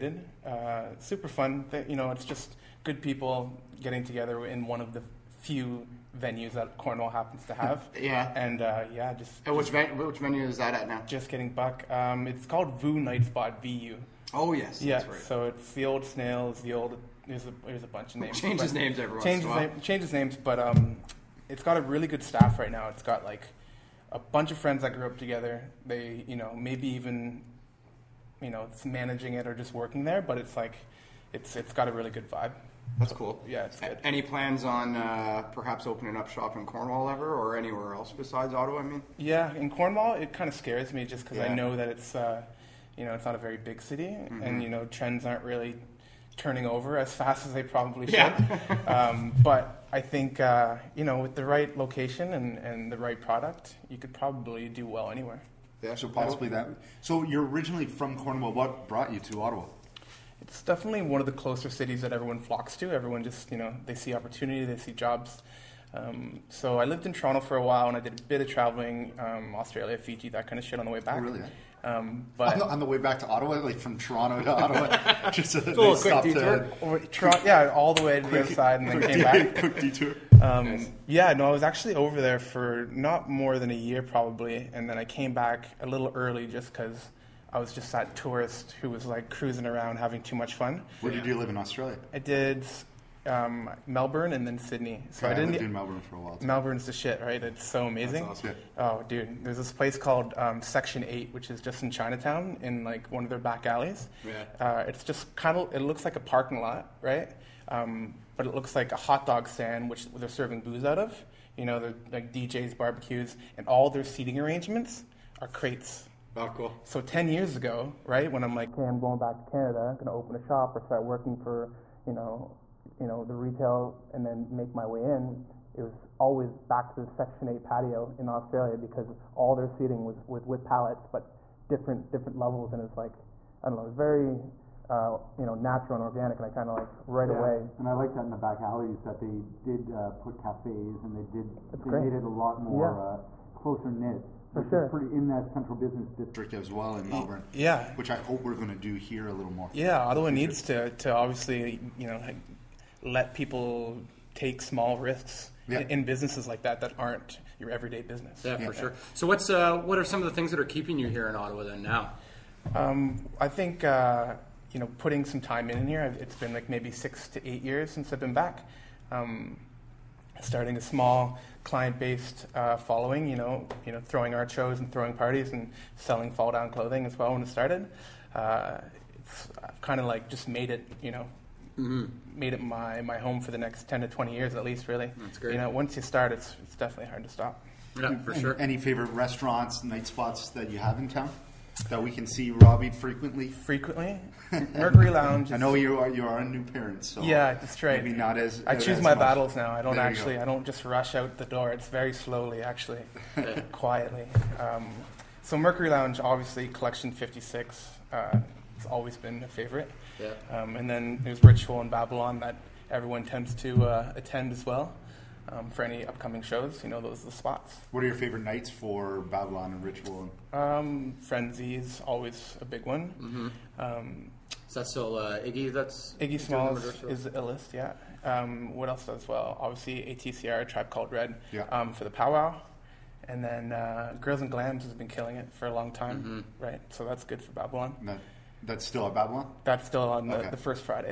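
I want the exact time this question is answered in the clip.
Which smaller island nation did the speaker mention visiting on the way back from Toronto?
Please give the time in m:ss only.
1:09.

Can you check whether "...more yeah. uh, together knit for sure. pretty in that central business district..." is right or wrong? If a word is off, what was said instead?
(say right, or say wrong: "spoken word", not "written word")
wrong: "closer", not "together".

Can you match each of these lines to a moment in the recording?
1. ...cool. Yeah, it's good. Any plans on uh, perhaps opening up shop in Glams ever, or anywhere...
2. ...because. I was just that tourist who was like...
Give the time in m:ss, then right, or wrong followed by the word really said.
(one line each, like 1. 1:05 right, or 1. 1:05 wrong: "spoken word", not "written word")
1. 0:33 wrong: "Cornwall", not "Glams"
2. 1:26 right.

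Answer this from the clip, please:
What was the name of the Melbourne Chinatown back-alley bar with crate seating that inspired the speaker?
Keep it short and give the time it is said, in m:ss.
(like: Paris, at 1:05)
Section Eight, at 1:40.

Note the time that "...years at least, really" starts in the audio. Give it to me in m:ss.
3:04.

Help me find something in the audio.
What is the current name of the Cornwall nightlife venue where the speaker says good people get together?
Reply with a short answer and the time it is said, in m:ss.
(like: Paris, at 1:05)
VU Night Spot, at 0:12.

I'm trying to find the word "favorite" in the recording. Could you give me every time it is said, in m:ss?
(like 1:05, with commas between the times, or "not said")
3:08, 3:29, 3:38.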